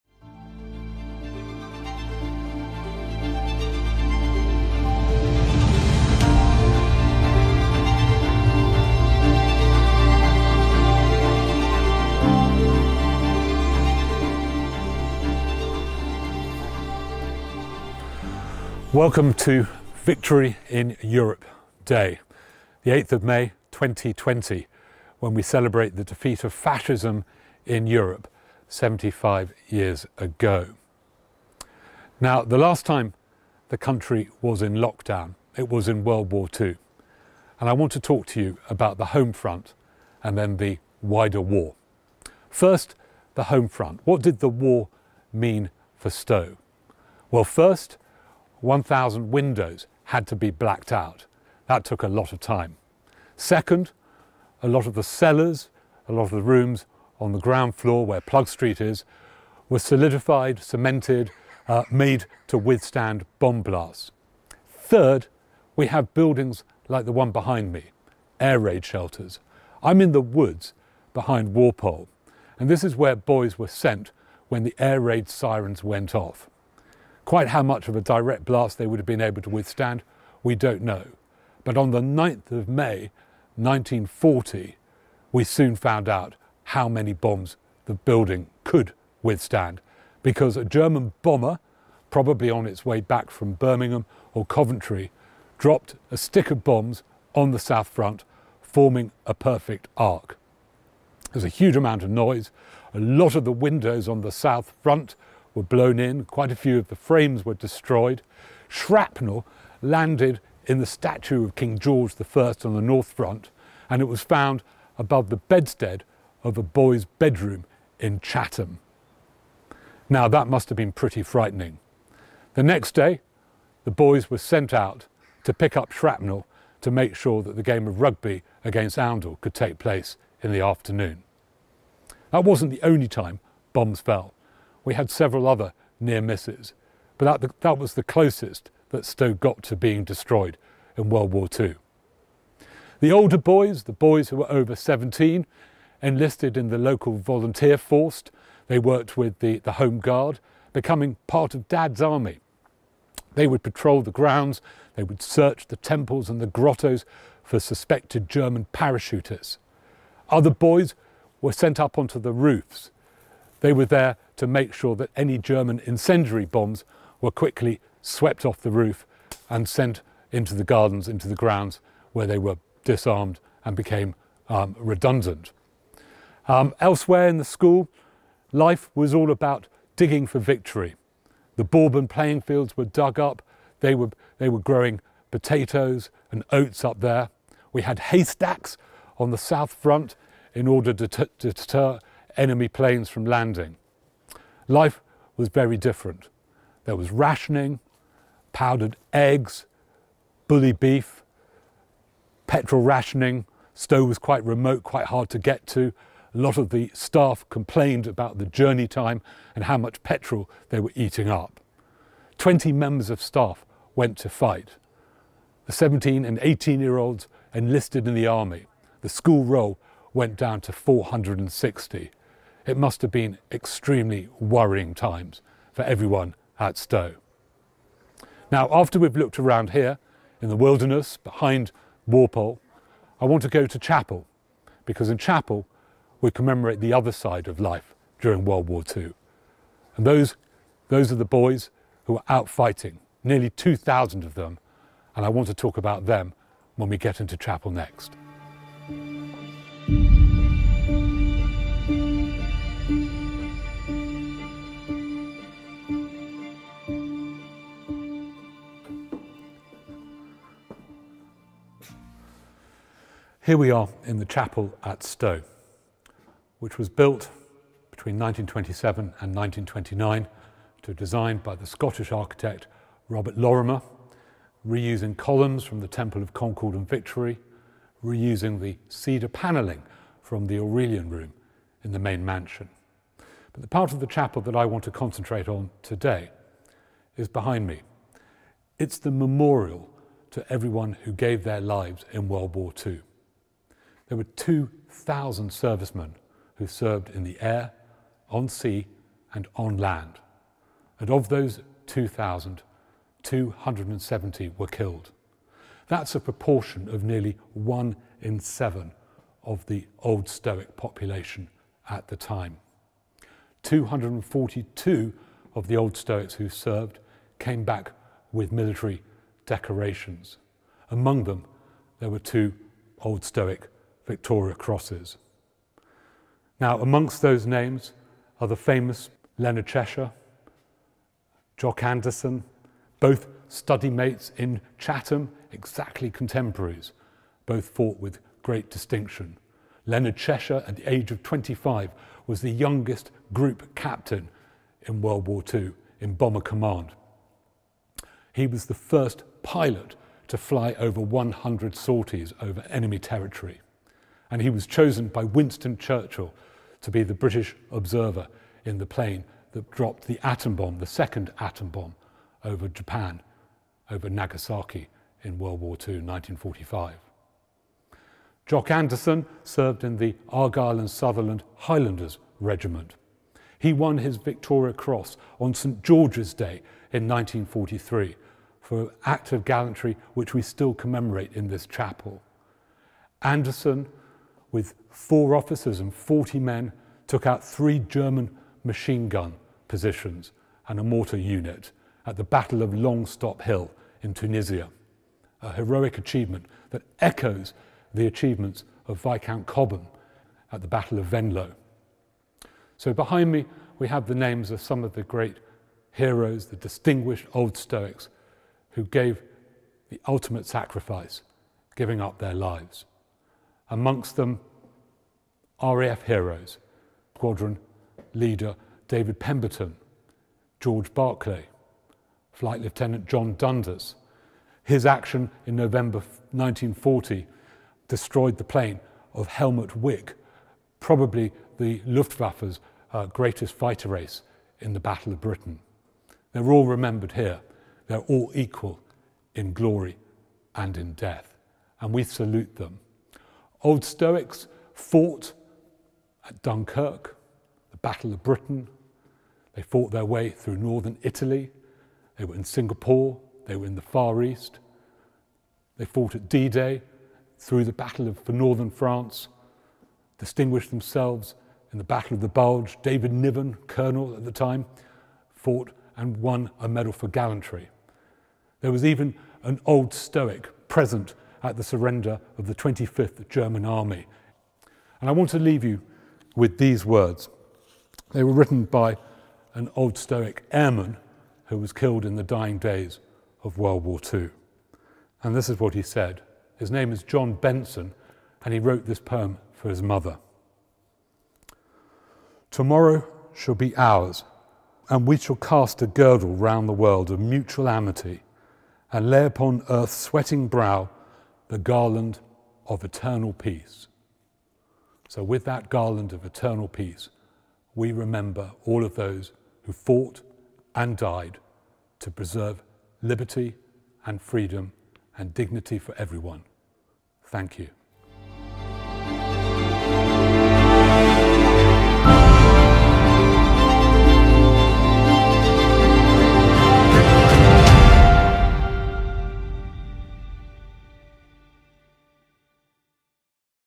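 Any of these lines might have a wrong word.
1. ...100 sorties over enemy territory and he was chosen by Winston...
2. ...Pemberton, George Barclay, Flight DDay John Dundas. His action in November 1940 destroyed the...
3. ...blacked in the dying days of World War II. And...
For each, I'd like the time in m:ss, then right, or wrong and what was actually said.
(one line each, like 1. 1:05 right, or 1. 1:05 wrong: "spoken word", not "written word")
1. 5:51 right
2. 6:59 wrong: "Lieutenant", not "DDay"
3. 8:01 wrong: "killed", not "blacked".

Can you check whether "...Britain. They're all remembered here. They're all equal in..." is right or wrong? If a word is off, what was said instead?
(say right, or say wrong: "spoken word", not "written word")
right.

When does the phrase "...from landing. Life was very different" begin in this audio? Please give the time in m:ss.
3:13.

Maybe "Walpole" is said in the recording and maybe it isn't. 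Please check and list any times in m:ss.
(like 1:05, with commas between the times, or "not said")
1:11, 3:52.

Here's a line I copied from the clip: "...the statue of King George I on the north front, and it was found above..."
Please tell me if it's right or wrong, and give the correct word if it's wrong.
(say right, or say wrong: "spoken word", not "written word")
right.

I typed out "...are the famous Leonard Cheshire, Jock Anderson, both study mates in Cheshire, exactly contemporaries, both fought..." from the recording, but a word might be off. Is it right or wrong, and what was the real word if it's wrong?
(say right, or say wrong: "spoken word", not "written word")
wrong: "Chatham", not "Cheshire".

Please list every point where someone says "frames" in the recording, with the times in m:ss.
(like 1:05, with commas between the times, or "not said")
1:46.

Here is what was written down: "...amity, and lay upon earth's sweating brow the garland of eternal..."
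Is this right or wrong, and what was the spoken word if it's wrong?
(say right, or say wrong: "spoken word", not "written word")
right.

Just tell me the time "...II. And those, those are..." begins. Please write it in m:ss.
3:58.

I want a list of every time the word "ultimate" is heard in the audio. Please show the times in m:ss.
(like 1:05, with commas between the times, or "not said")
6:50.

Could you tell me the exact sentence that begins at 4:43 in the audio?
But the part of the chapel that I want to concentrate on today is behind me.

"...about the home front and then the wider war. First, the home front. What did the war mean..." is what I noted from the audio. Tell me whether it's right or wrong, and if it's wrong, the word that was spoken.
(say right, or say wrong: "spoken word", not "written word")
right.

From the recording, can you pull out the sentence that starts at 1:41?
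There's a huge amount of noise.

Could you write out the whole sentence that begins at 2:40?
Other boys were sent up onto the roofs.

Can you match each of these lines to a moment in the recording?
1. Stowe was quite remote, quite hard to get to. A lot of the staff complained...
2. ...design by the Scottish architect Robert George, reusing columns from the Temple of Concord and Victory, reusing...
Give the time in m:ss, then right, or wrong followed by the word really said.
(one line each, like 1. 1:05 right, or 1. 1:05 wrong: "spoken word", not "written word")
1. 3:23 right
2. 4:30 wrong: "Lorimer", not "George".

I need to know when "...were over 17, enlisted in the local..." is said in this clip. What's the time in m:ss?
2:24.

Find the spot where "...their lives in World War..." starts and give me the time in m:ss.
4:51.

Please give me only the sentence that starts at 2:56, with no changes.
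Um, elsewhere in the school, life was all about digging for victory.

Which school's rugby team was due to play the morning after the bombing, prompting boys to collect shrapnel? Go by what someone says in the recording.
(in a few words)
Oundle.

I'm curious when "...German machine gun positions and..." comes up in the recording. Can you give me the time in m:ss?
6:27.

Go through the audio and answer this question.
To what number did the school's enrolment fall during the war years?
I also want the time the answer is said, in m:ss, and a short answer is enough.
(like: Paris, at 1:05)
460, at 3:40.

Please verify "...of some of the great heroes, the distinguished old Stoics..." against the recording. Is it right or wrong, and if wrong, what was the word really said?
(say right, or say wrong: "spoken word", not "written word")
right.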